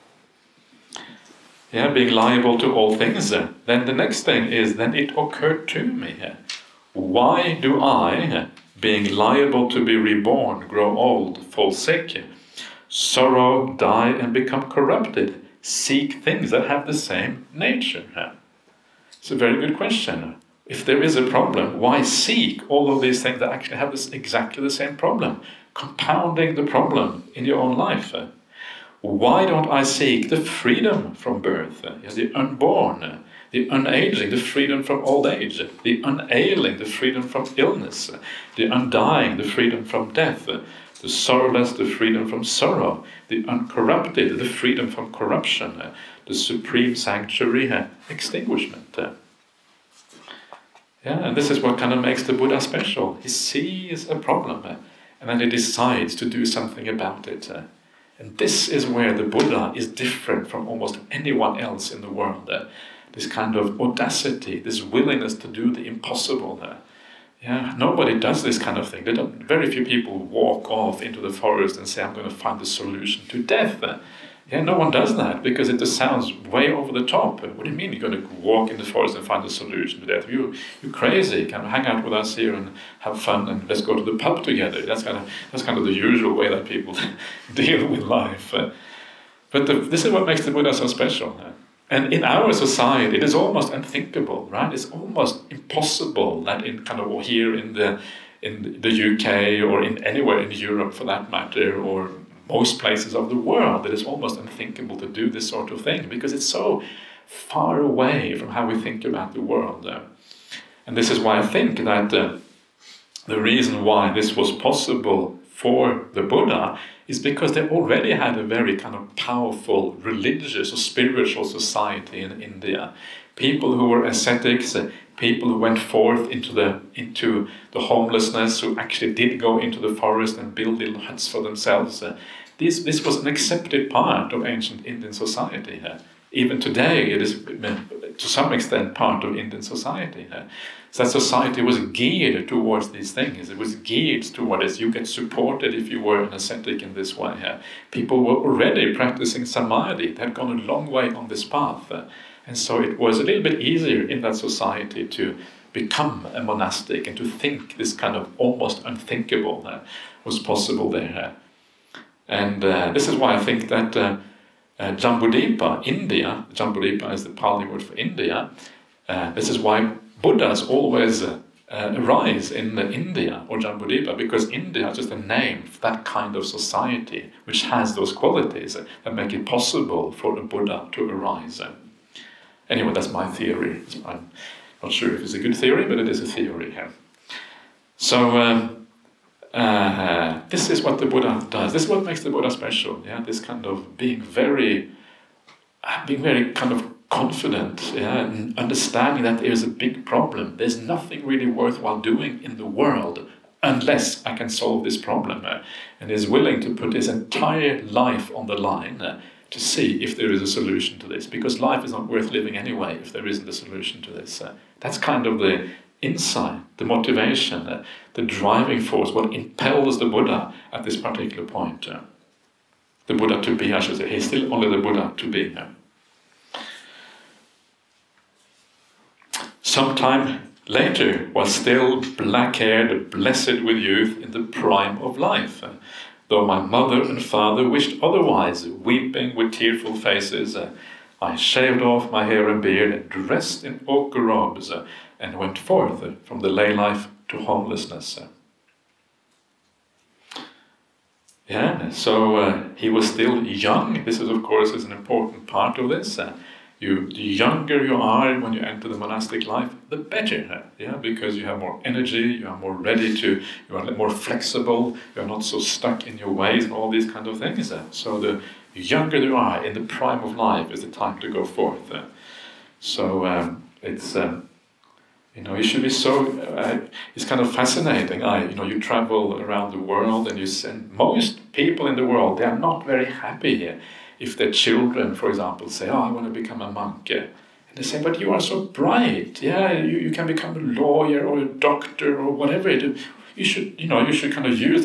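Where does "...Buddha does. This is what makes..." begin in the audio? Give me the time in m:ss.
3:11.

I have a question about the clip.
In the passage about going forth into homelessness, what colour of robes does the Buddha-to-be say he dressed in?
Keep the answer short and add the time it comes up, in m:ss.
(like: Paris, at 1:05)
Ochre, at 4:03.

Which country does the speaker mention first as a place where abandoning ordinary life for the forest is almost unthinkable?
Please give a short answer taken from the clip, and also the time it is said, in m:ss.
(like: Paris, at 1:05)
The UK, at 1:38.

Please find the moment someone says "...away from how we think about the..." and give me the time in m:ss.
1:47.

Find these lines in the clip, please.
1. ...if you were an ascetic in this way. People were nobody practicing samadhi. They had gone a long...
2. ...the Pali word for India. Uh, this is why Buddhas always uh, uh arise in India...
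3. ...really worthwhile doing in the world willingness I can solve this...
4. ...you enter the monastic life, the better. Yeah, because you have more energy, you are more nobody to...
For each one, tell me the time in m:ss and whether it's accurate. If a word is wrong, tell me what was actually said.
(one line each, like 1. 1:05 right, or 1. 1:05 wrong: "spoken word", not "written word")
1. 2:25 wrong: "already", not "nobody"
2. 2:47 right
3. 3:21 wrong: "unless", not "willingness"
4. 4:18 wrong: "ready", not "nobody".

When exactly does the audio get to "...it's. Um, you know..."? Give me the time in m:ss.
4:33.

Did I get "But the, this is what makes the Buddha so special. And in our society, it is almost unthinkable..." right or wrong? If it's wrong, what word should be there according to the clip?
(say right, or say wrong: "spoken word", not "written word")
right.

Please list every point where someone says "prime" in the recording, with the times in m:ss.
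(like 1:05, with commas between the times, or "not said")
3:54, 4:29.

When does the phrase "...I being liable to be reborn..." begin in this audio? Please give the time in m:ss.
0:07.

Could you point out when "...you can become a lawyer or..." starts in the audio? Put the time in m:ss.
4:49.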